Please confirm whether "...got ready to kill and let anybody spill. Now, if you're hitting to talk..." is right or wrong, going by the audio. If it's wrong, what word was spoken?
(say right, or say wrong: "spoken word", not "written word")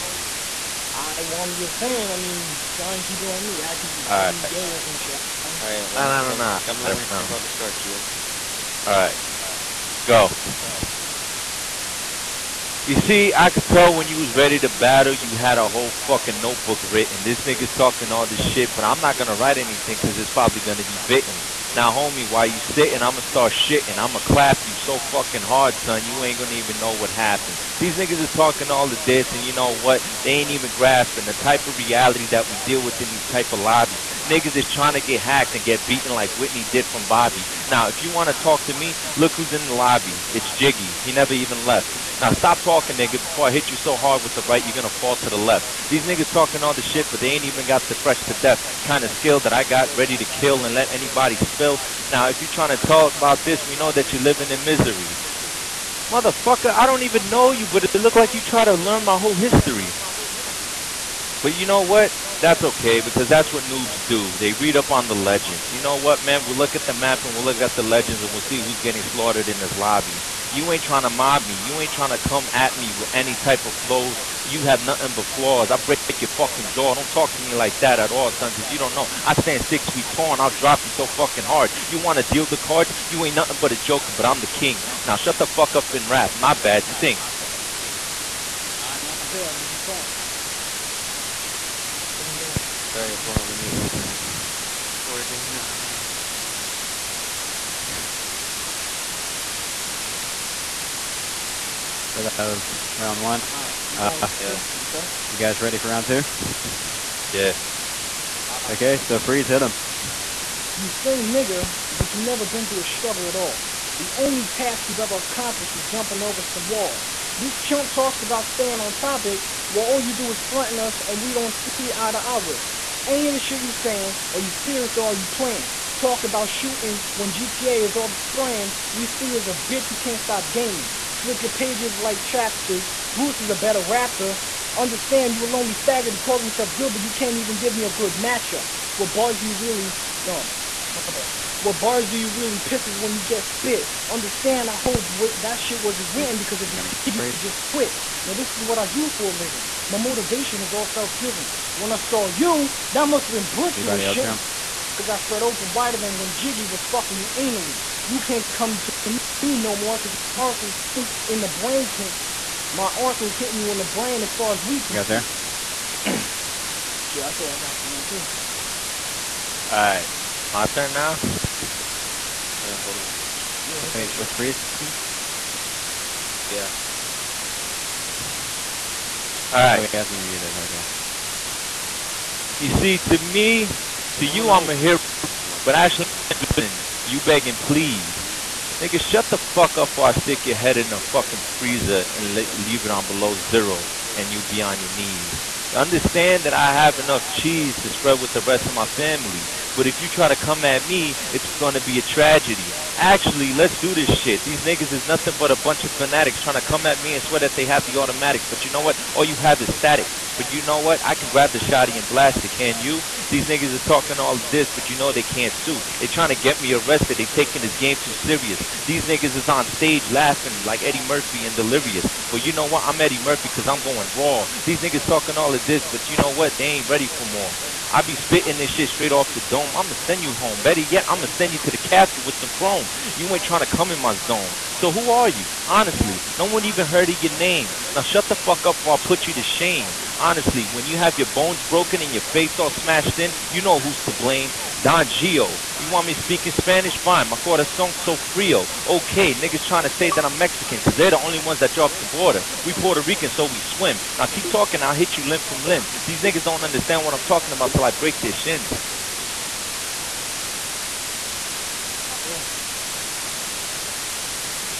wrong: "trying", not "hitting".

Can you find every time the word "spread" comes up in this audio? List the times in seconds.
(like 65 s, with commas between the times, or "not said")
155 s, 197 s.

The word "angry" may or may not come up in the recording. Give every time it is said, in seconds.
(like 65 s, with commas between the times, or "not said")
not said.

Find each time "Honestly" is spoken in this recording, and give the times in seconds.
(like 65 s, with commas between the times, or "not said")
235 s, 240 s.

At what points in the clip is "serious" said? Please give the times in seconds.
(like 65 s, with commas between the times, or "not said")
124 s, 218 s.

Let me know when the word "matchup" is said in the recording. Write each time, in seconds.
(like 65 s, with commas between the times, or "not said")
138 s.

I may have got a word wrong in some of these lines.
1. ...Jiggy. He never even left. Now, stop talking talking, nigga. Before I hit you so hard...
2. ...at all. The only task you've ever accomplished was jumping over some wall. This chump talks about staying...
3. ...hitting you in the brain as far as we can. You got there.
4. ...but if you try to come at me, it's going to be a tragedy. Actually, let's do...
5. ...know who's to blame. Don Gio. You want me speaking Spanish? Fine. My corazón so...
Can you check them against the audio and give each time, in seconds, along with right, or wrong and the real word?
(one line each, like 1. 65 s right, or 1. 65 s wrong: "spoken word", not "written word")
1. 40 s right
2. 113 s right
3. 163 s right
4. 199 s right
5. 243 s right.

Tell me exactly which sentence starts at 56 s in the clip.
Motherfucker, I don't even know you, but it look like you try to learn my whole history.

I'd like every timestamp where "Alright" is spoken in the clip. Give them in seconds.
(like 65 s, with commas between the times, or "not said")
92 s, 103 s, 172 s, 179 s.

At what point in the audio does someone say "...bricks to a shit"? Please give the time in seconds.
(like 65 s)
153 s.